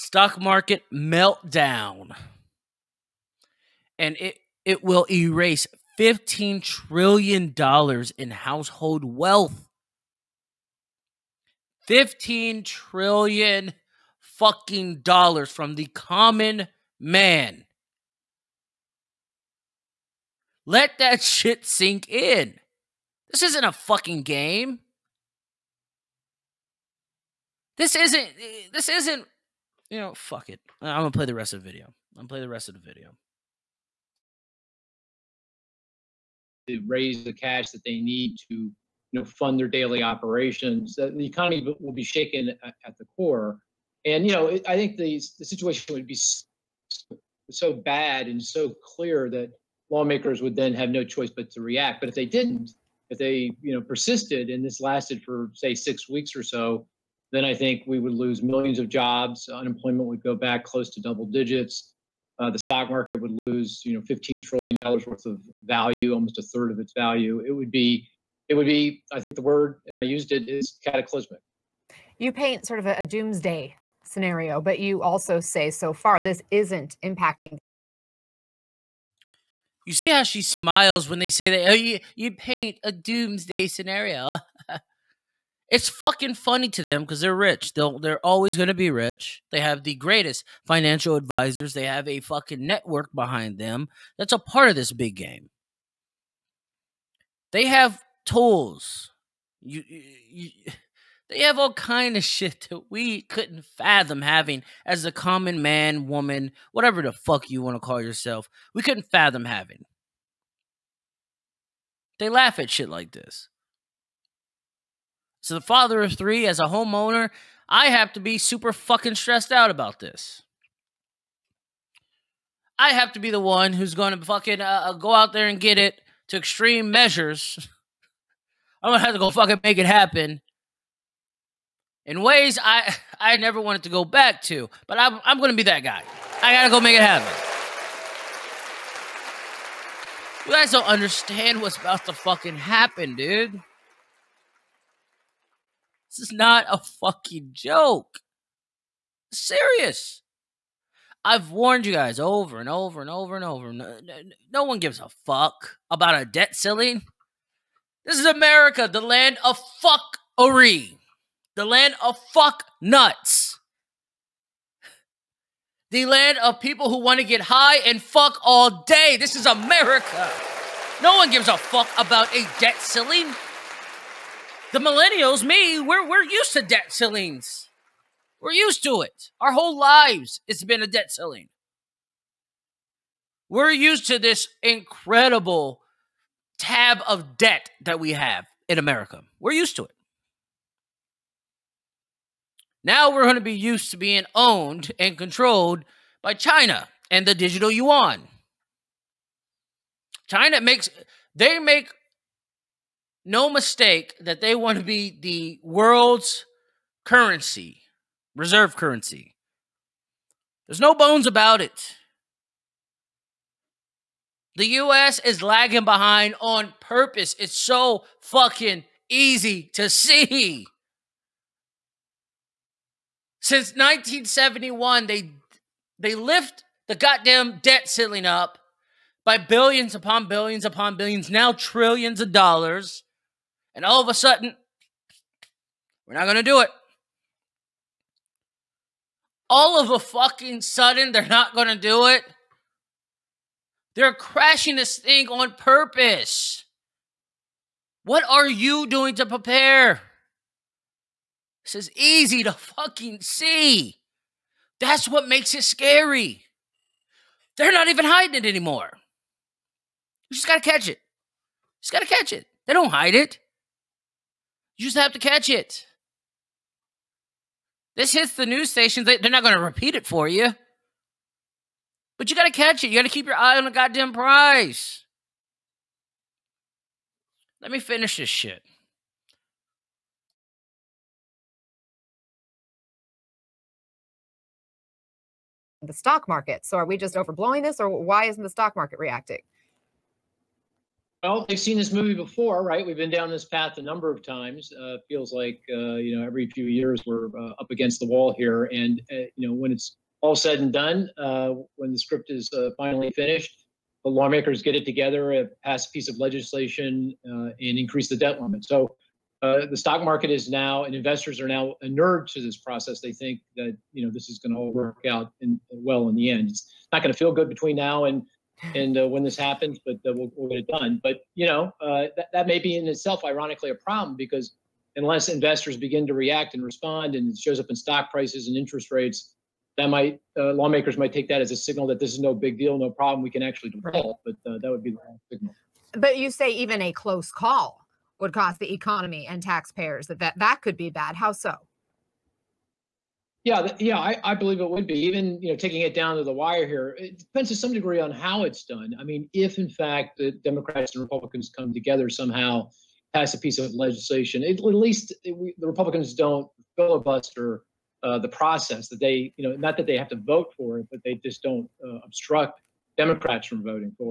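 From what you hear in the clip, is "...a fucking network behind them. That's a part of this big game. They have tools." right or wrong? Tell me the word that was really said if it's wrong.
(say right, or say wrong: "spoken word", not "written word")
right.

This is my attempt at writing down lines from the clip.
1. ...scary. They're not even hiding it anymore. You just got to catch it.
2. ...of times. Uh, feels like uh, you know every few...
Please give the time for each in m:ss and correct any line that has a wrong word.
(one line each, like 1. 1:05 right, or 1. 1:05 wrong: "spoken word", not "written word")
1. 4:15 right
2. 4:54 right.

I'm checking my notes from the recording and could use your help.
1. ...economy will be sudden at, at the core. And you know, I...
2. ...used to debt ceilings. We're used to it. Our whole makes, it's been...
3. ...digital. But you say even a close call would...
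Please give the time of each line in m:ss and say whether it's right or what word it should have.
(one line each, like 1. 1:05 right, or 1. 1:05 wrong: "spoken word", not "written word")
1. 0:41 wrong: "shaken", not "sudden"
2. 2:56 wrong: "lives", not "makes"
3. 5:35 wrong: "signal", not "digital".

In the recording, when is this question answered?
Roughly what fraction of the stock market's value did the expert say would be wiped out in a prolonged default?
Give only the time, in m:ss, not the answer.
1:06.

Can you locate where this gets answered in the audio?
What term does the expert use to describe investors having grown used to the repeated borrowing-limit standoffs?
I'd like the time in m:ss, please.
5:11.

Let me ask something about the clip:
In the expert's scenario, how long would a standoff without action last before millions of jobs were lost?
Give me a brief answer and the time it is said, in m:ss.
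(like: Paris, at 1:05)
6 weeks, at 0:55.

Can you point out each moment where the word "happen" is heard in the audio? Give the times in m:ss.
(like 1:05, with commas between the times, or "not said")
2:09, 2:17, 2:22, 5:19.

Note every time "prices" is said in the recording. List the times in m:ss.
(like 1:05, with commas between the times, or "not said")
5:28.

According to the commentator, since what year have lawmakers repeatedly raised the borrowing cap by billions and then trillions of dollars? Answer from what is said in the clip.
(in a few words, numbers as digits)
1971.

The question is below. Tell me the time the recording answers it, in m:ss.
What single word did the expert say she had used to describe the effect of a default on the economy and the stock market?
1:10.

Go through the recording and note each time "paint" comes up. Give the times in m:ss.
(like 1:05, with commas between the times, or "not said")
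1:12, 1:22.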